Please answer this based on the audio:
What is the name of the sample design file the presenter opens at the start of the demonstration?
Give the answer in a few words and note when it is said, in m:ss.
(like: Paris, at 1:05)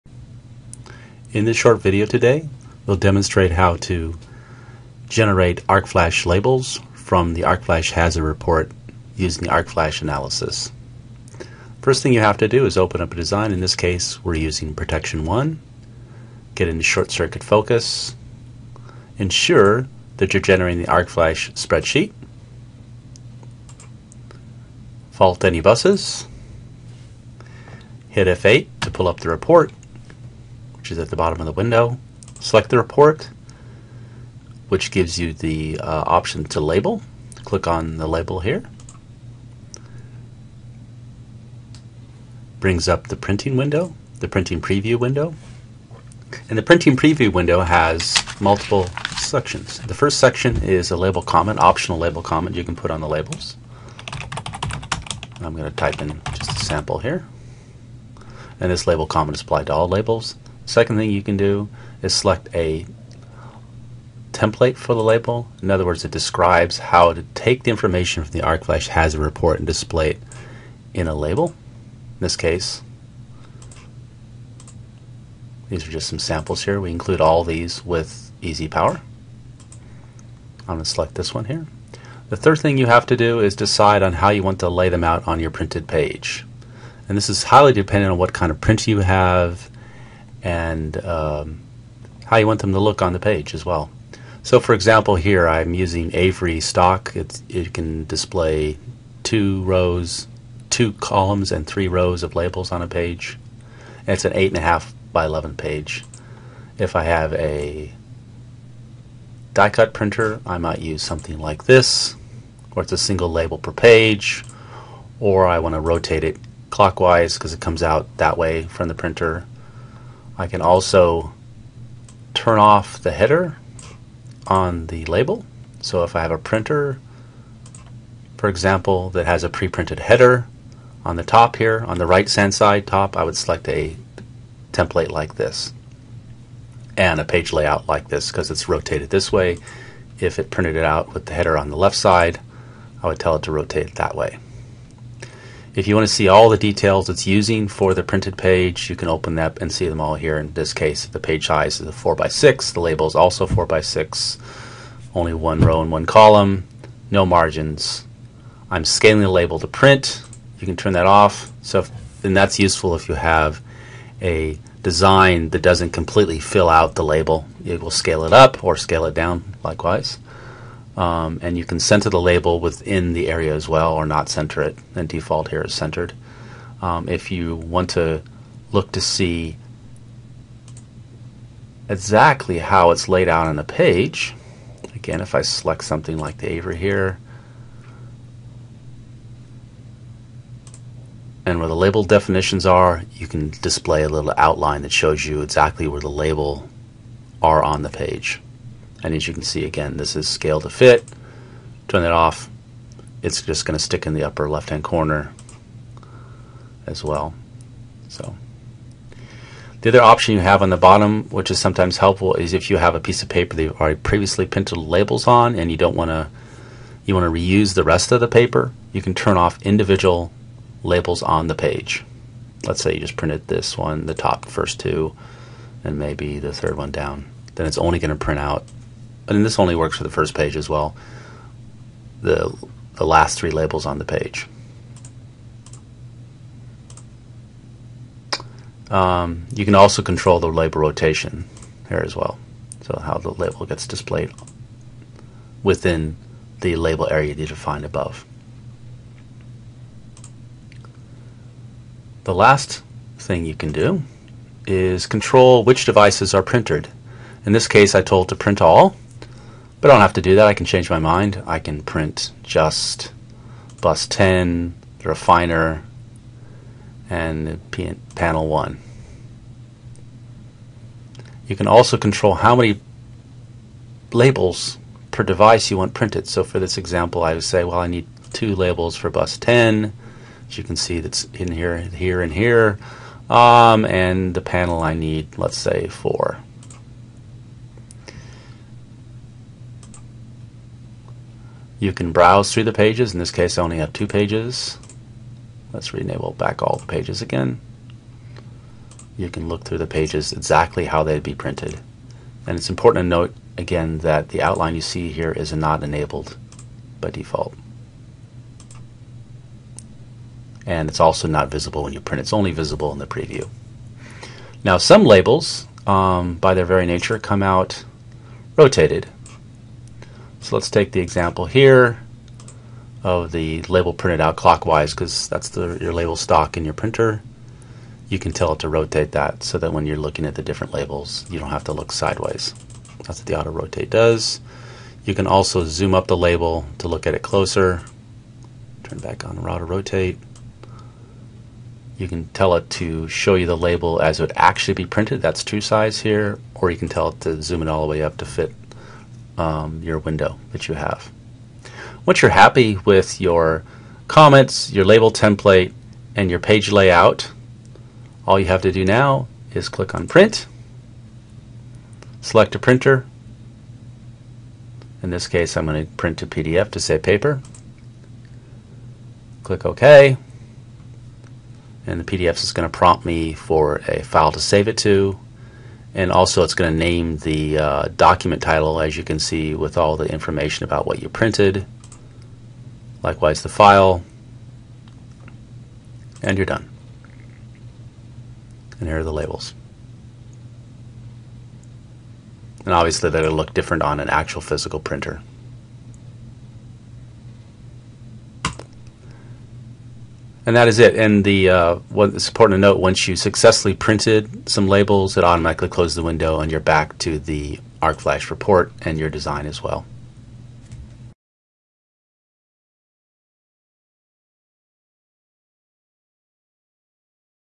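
Protection 1, at 0:14.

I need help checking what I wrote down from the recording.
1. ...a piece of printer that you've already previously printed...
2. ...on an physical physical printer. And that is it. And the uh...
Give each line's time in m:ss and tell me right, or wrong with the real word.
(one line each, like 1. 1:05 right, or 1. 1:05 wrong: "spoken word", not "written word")
1. 3:32 wrong: "paper", not "printer"
2. 6:33 wrong: "actual", not "physical".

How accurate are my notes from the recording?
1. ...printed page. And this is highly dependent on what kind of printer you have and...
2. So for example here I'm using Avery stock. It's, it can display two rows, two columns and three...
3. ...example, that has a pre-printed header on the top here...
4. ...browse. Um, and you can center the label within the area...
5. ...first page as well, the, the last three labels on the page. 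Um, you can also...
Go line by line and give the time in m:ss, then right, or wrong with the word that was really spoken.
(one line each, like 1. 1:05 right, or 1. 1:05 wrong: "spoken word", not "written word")
1. 1:25 right
2. 1:34 right
3. 2:08 right
4. 2:49 wrong: "likewise", not "browse"
5. 3:50 right.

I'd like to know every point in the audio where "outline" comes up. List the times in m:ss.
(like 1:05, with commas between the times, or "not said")
3:14, 5:04.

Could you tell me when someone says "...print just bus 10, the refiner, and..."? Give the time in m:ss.
4:21.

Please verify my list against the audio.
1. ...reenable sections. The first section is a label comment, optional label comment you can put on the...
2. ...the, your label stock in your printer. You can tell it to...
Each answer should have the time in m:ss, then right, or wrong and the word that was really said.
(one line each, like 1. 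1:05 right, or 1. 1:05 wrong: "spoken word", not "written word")
1. 0:48 wrong: "multiple", not "reenable"
2. 5:25 right.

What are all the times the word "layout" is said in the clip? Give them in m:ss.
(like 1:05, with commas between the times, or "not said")
2:17, 5:56.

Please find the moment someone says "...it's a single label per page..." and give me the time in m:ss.
1:52.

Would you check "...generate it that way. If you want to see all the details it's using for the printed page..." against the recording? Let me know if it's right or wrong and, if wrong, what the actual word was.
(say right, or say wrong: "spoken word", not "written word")
wrong: "rotate", not "generate".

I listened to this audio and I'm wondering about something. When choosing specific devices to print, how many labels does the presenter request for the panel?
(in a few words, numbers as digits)
4.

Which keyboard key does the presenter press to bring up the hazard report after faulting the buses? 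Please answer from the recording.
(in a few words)
F8.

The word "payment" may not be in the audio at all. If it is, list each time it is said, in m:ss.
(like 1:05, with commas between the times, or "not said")
not said.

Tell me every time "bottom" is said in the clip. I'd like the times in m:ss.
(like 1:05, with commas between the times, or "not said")
0:31, 3:30.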